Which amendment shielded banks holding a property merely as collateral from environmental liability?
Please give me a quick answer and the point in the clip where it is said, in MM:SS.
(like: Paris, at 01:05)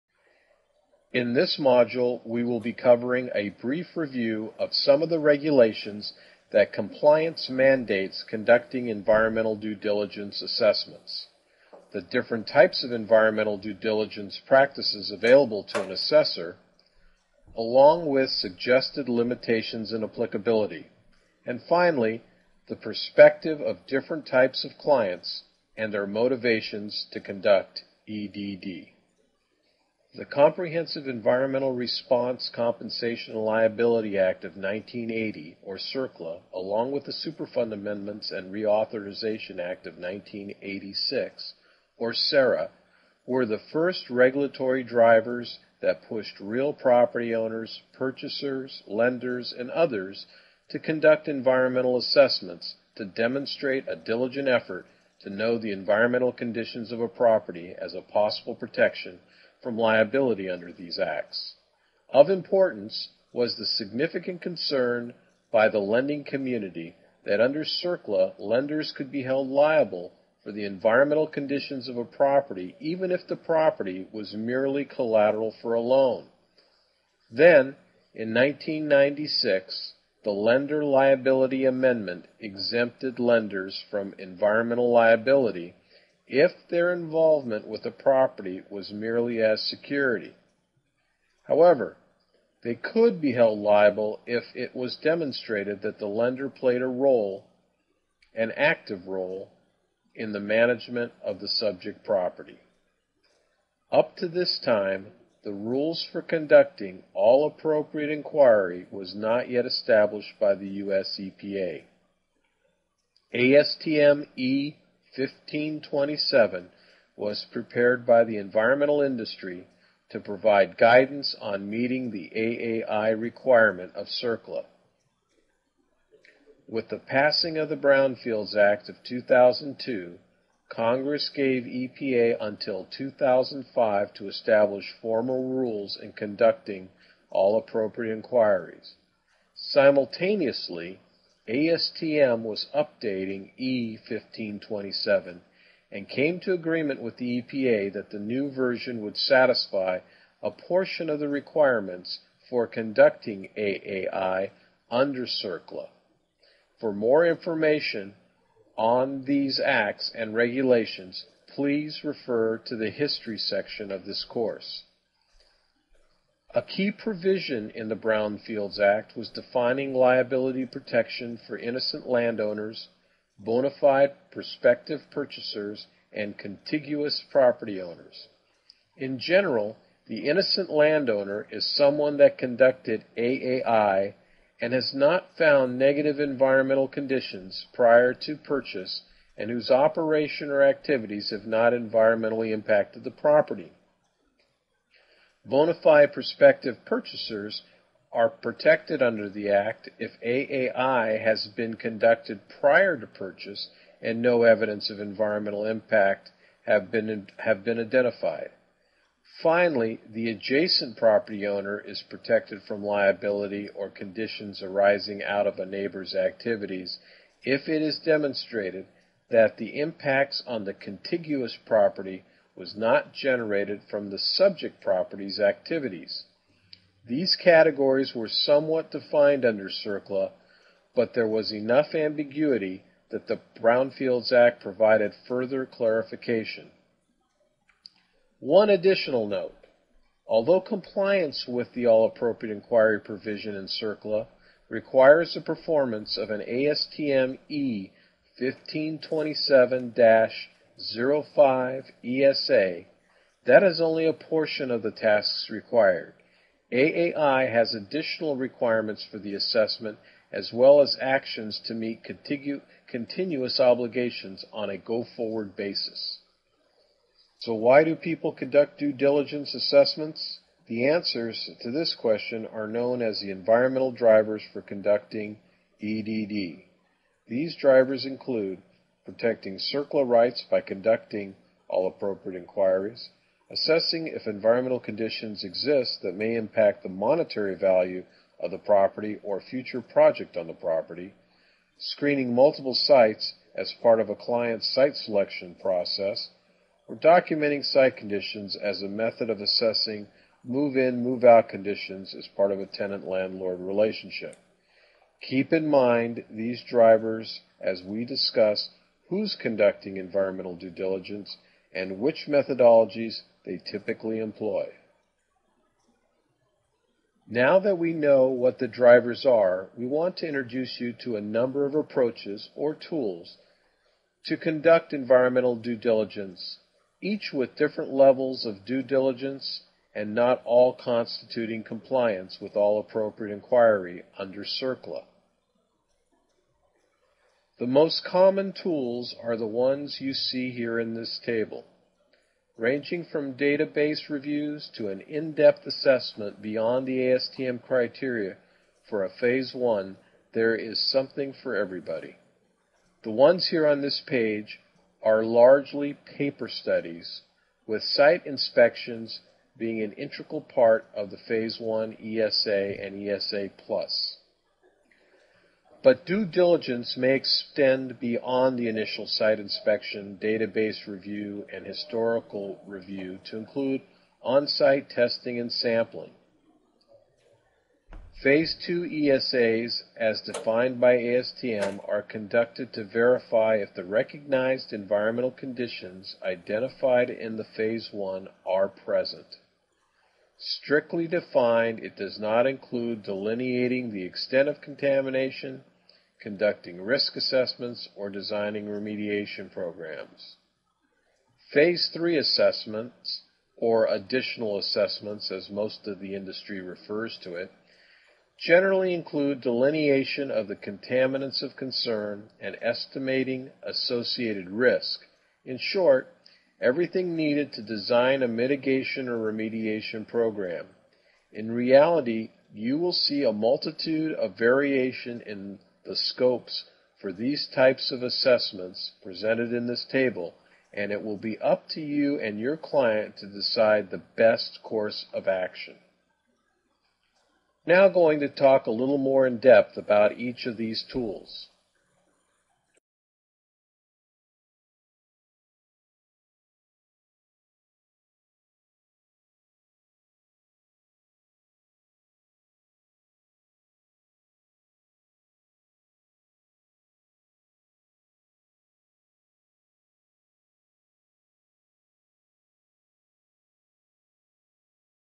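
Lender Liability Amendment, at 01:20.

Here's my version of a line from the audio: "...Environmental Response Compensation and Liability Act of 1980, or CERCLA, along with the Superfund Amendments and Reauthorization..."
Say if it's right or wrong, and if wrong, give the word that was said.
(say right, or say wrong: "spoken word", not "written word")
right.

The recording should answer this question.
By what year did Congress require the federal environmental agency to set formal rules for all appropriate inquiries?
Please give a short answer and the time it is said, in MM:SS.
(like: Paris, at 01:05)
2005, at 02:12.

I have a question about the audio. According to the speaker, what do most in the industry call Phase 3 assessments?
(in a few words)
additional assessments.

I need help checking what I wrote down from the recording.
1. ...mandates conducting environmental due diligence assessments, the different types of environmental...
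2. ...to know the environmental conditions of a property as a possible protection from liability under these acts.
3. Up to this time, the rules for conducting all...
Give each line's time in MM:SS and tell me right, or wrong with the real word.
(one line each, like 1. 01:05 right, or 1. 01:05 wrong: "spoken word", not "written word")
1. 00:07 right
2. 00:55 right
3. 01:43 right.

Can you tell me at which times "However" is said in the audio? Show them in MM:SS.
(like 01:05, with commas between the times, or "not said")
01:31.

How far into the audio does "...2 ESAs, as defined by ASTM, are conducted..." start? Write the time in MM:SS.
06:18.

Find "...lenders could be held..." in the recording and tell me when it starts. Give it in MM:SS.
01:08.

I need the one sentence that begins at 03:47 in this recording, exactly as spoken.
These categories were somewhat defined under CERCLA, but there was enough ambiguity that the Brownfields Act provided further clarification.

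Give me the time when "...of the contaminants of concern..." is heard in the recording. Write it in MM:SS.
06:50.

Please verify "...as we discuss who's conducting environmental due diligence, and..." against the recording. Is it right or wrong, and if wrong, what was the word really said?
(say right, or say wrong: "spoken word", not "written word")
right.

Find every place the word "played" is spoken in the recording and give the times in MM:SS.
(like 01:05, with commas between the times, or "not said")
01:36.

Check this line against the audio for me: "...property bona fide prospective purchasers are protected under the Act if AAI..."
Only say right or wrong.
right.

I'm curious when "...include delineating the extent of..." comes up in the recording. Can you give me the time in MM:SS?
06:32.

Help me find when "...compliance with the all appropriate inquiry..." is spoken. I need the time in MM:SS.
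04:00.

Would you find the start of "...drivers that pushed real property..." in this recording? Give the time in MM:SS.
00:44.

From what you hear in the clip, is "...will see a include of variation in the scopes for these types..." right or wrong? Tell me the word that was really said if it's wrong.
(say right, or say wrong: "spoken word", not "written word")
wrong: "multitude", not "include".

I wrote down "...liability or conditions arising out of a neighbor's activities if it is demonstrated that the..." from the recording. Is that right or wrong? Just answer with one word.
right.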